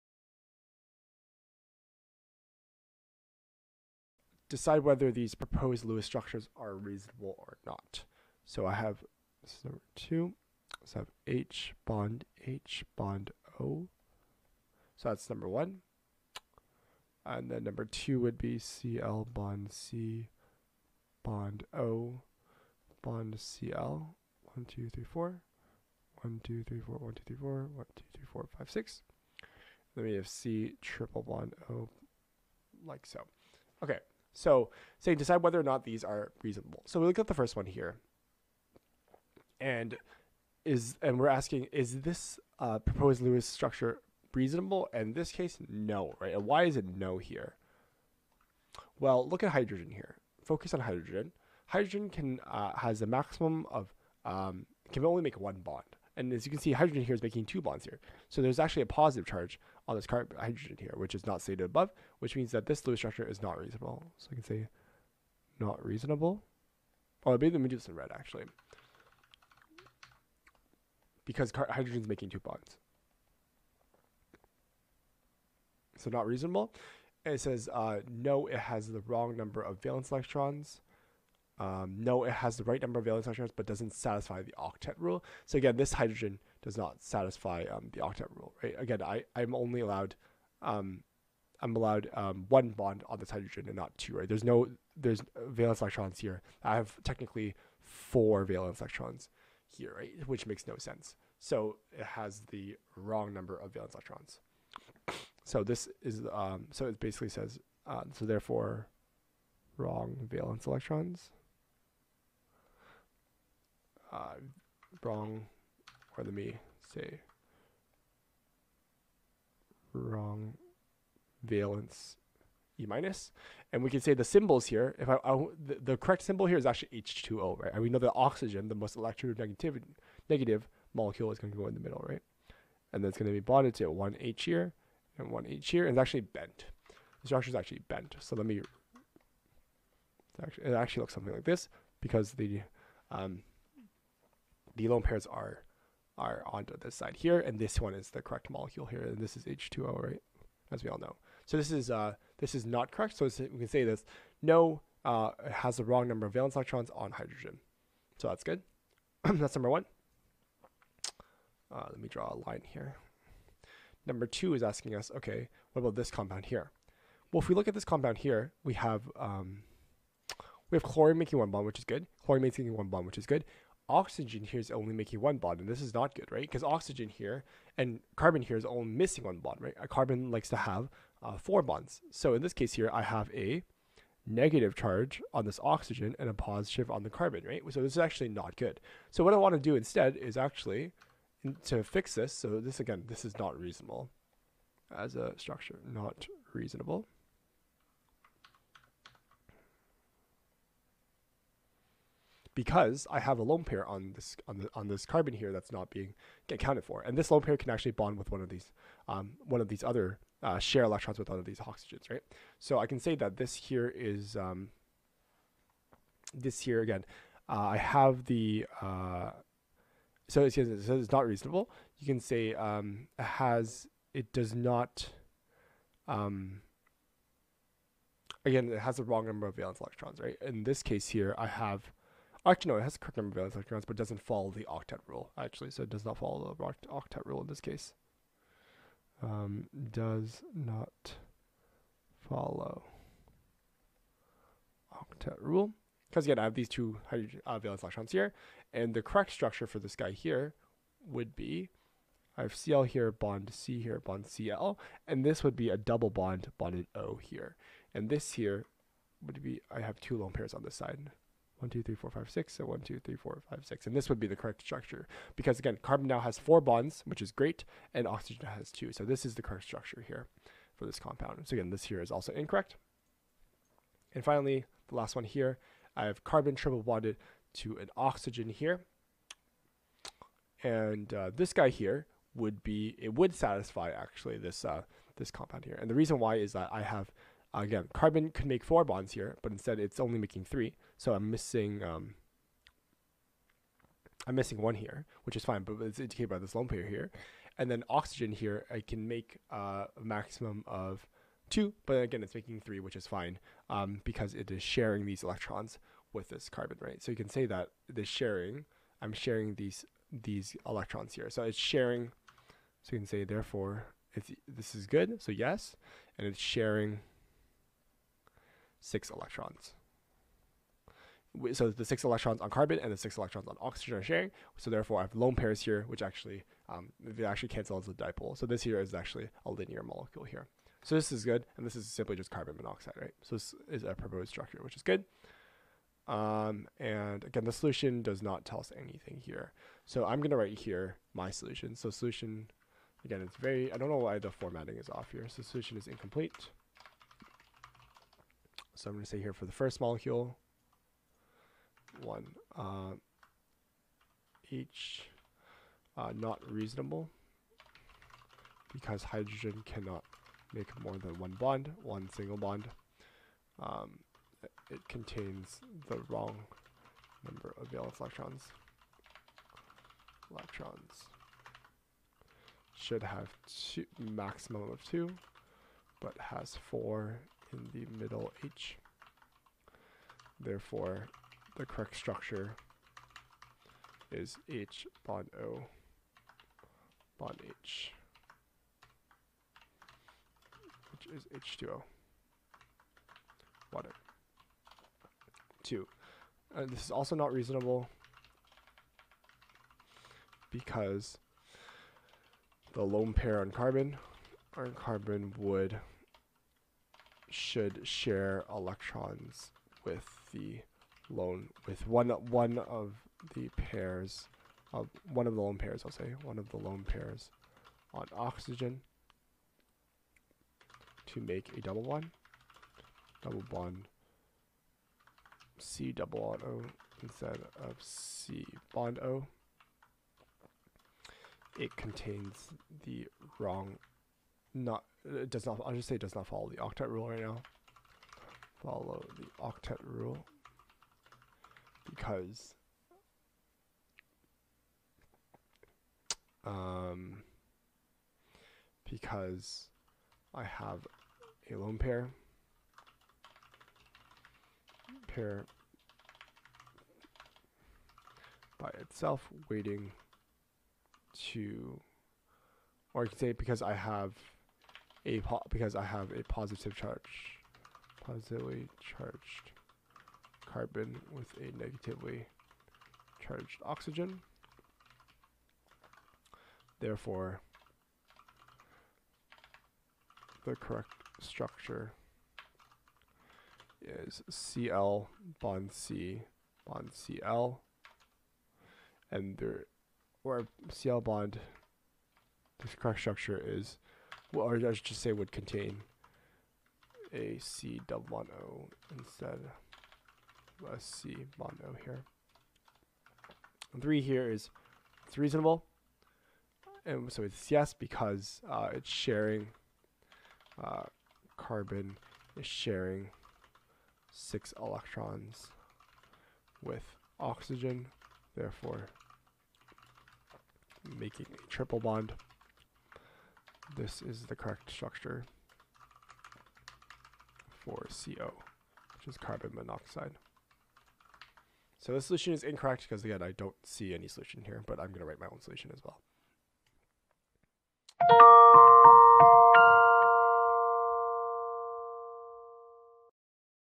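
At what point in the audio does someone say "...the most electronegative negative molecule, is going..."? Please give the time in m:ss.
2:08.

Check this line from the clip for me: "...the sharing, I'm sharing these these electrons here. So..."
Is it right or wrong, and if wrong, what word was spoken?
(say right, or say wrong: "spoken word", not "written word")
right.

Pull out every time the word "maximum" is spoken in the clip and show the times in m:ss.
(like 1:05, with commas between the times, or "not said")
0:53, 5:00, 6:13.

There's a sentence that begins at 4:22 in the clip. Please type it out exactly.
So one, two, three, four, five, six.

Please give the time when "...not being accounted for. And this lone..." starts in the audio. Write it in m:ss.
3:25.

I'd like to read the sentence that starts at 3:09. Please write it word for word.
So what I want to do instead is actually to fix this.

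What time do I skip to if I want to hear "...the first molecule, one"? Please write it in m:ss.
5:49.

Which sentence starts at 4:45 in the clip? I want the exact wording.
And the reason why is that I have again, carbon could make four bonds here, but instead it's only making three.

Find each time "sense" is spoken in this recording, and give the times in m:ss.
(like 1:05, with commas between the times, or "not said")
1:40.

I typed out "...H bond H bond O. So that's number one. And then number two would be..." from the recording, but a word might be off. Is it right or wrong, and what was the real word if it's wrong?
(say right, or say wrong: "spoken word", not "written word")
right.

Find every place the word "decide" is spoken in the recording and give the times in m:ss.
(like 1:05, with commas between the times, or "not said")
0:04, 0:35.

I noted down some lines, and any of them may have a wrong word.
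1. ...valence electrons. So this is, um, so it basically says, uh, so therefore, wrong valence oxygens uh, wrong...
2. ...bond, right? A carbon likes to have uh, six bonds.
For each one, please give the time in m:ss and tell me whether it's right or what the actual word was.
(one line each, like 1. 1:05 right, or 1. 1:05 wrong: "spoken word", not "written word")
1. 1:43 wrong: "electrons", not "oxygens"
2. 2:59 wrong: "four", not "six".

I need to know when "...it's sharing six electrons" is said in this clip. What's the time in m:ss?
5:16.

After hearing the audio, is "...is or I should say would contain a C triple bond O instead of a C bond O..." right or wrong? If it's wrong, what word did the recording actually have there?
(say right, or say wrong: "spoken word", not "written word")
wrong: "double", not "triple".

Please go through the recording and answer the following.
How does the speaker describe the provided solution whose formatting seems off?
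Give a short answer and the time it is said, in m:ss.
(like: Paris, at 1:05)
incomplete, at 5:45.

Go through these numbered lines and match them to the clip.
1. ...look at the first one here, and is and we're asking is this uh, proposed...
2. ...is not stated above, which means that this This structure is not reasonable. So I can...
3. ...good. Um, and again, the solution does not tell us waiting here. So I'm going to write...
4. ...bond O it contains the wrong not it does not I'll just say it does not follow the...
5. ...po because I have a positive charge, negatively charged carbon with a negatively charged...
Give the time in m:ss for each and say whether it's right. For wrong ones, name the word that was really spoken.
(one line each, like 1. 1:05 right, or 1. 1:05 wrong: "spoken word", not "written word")
1. 0:37 right
2. 1:01 wrong: "Lewis", not "This"
3. 5:34 wrong: "anything", not "waiting"
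4. 7:08 right
5. 7:45 wrong: "positively", not "negatively".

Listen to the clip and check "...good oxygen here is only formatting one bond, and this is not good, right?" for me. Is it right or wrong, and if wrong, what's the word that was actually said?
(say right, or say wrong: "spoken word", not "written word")
wrong: "making", not "formatting".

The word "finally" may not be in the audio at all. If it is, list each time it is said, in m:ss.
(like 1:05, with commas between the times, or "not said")
4:34.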